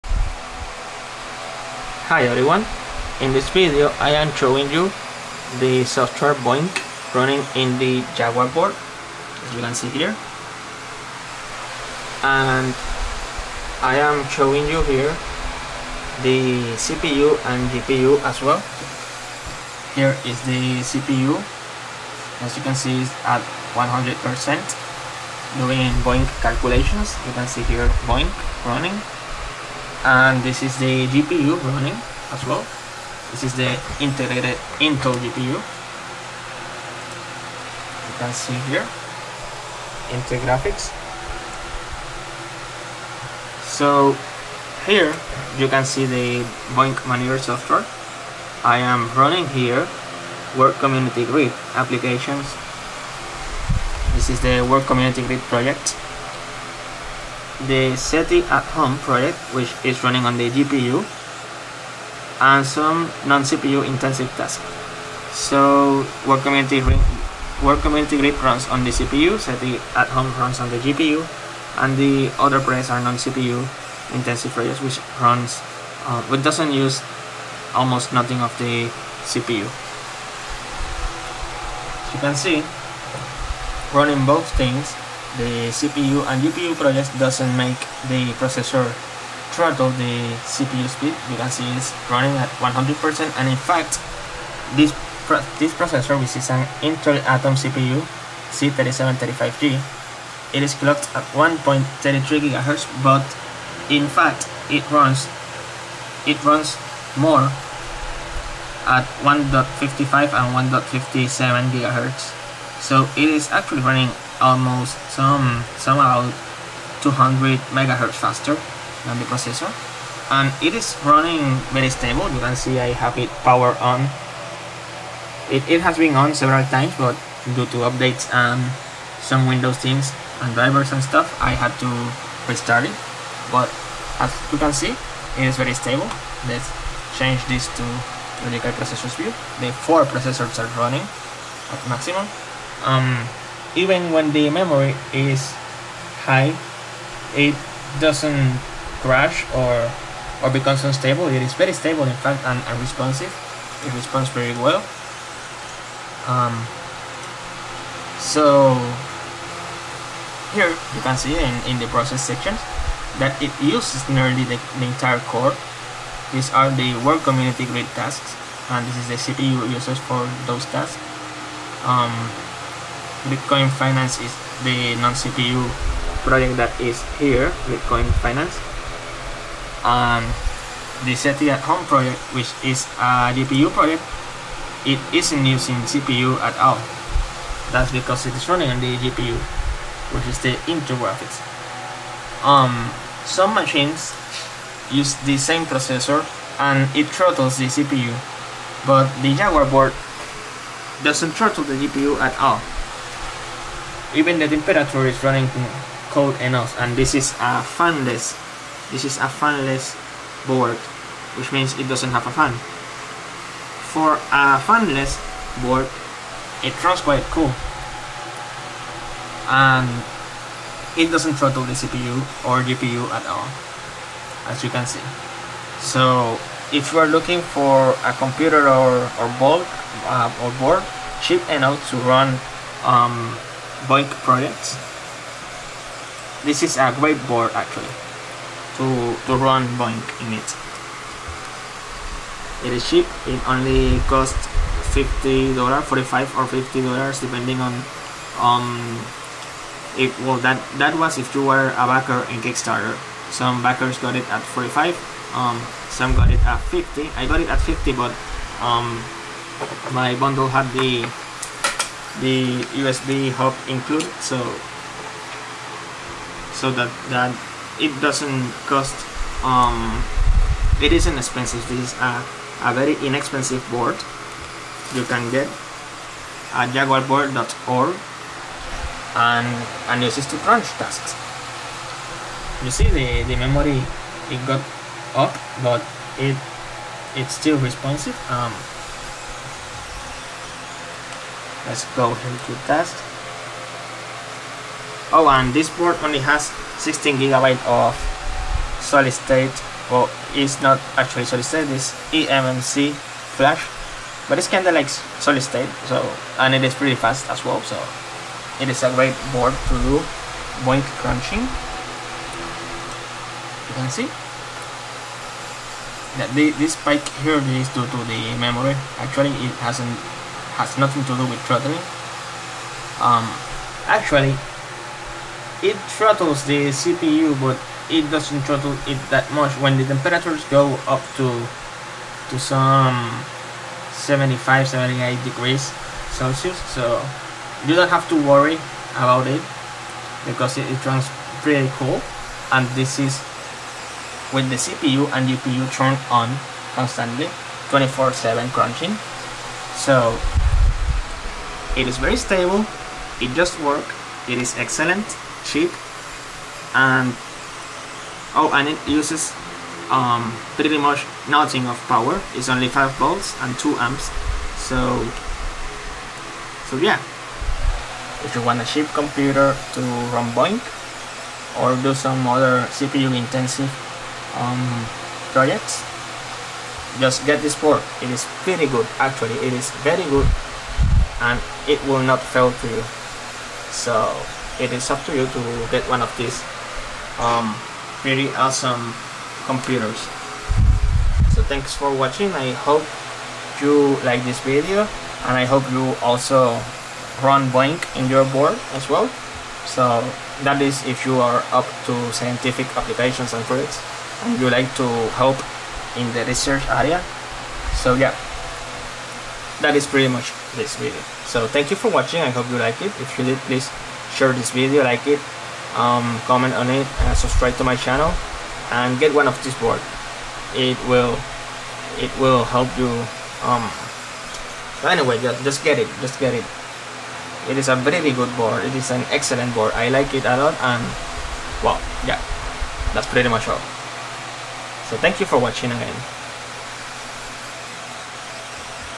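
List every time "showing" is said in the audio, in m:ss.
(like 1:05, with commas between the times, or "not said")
0:04, 0:14.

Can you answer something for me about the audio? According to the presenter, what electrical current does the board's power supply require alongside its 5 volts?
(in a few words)
2 amps.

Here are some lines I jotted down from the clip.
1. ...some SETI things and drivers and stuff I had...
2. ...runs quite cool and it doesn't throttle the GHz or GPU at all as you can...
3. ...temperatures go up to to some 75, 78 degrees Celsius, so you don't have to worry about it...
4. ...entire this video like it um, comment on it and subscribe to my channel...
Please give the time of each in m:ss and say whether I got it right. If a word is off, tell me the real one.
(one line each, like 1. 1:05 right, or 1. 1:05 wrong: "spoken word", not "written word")
1. 2:09 wrong: "Windows", not "SETI"
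2. 3:36 wrong: "CPU", not "GHz"
3. 5:29 right
4. 6:54 wrong: "share", not "entire".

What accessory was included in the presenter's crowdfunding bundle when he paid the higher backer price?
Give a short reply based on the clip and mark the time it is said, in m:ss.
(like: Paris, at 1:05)
USB hub, at 4:22.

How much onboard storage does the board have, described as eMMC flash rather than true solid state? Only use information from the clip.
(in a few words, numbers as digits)
16 GB.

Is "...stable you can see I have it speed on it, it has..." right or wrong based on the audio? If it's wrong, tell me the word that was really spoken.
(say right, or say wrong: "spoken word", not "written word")
wrong: "powered", not "speed".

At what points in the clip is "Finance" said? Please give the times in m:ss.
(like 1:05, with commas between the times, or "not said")
2:53, 2:58.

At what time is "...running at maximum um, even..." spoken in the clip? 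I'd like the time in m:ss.
2:20.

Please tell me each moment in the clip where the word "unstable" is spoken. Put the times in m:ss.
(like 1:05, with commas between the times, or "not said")
2:30.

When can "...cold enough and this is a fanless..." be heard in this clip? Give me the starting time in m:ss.
3:26.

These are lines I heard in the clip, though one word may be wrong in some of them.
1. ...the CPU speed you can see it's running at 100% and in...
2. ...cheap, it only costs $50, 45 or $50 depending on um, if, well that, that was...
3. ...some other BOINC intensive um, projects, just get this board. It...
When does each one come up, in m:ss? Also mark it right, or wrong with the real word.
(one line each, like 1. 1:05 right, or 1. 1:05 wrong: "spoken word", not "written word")
1. 1:29 right
2. 4:02 right
3. 6:11 wrong: "CPU", not "BOINC".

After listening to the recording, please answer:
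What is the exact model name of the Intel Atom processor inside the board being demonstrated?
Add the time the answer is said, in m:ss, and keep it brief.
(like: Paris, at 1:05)
Z3735G, at 1:38.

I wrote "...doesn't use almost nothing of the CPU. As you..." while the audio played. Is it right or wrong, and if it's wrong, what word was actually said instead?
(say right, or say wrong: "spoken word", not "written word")
right.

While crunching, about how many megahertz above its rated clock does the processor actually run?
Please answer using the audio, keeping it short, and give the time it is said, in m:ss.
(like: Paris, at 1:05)
200 MHz, at 1:57.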